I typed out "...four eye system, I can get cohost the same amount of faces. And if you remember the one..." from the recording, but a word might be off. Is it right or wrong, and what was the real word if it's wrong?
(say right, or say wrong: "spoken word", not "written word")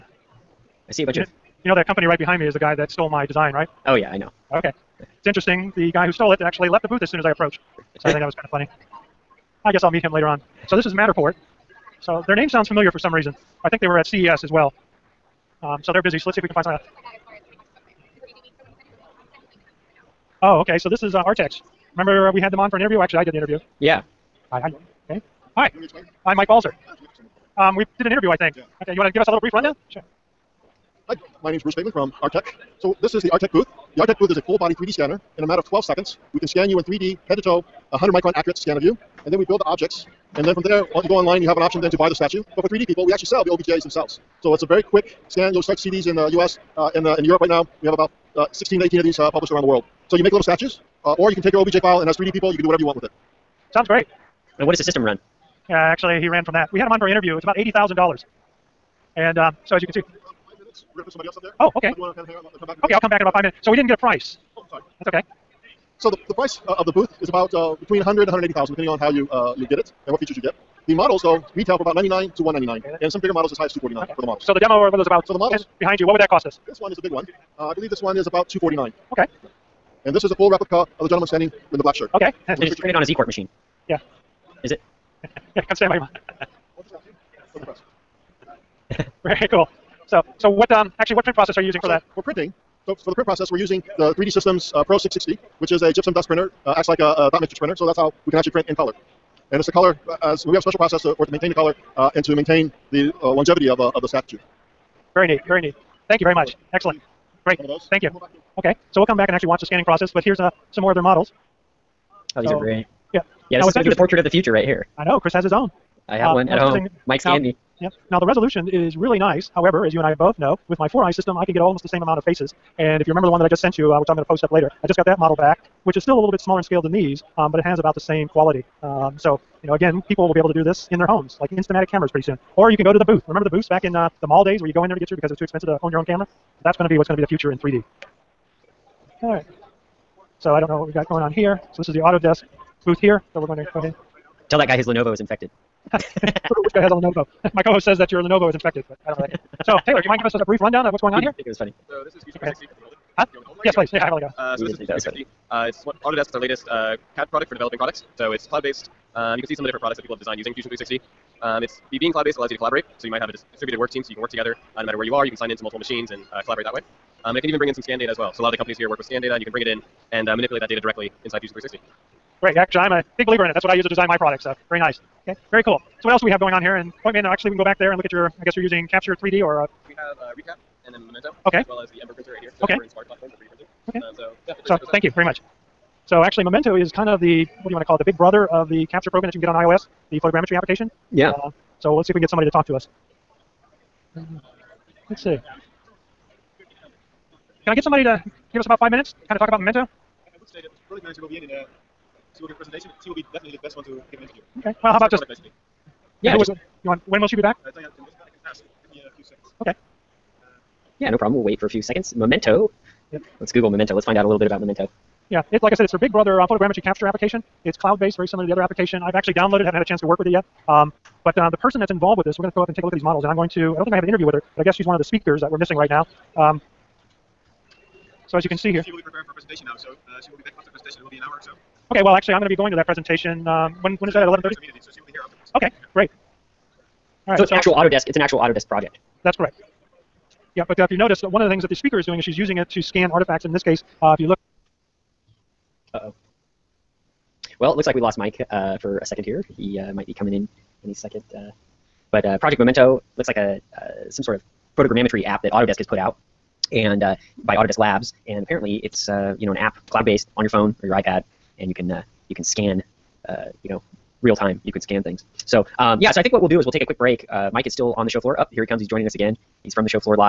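wrong: "almost", not "cohost".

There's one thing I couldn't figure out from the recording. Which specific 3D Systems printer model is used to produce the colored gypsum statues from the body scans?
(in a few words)
Pro 660.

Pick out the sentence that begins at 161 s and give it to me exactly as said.
Um, it's being cloud-based allows you to collaborate.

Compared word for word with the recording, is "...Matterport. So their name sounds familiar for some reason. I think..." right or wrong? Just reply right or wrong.
right.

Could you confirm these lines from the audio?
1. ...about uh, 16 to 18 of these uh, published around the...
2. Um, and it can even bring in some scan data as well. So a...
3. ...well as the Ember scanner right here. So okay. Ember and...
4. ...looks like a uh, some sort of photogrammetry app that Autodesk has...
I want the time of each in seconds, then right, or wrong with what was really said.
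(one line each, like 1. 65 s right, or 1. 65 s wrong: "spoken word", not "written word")
1. 47 s right
2. 167 s right
3. 181 s wrong: "printer", not "scanner"
4. 253 s right.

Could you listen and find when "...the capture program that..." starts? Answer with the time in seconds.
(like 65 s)
188 s.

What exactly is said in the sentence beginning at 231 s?
Okay, well, actually, I'm going to be going to that presentation.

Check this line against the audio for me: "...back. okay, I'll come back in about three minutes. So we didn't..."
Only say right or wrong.
wrong.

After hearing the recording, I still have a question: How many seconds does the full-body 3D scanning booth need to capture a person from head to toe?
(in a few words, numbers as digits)
12.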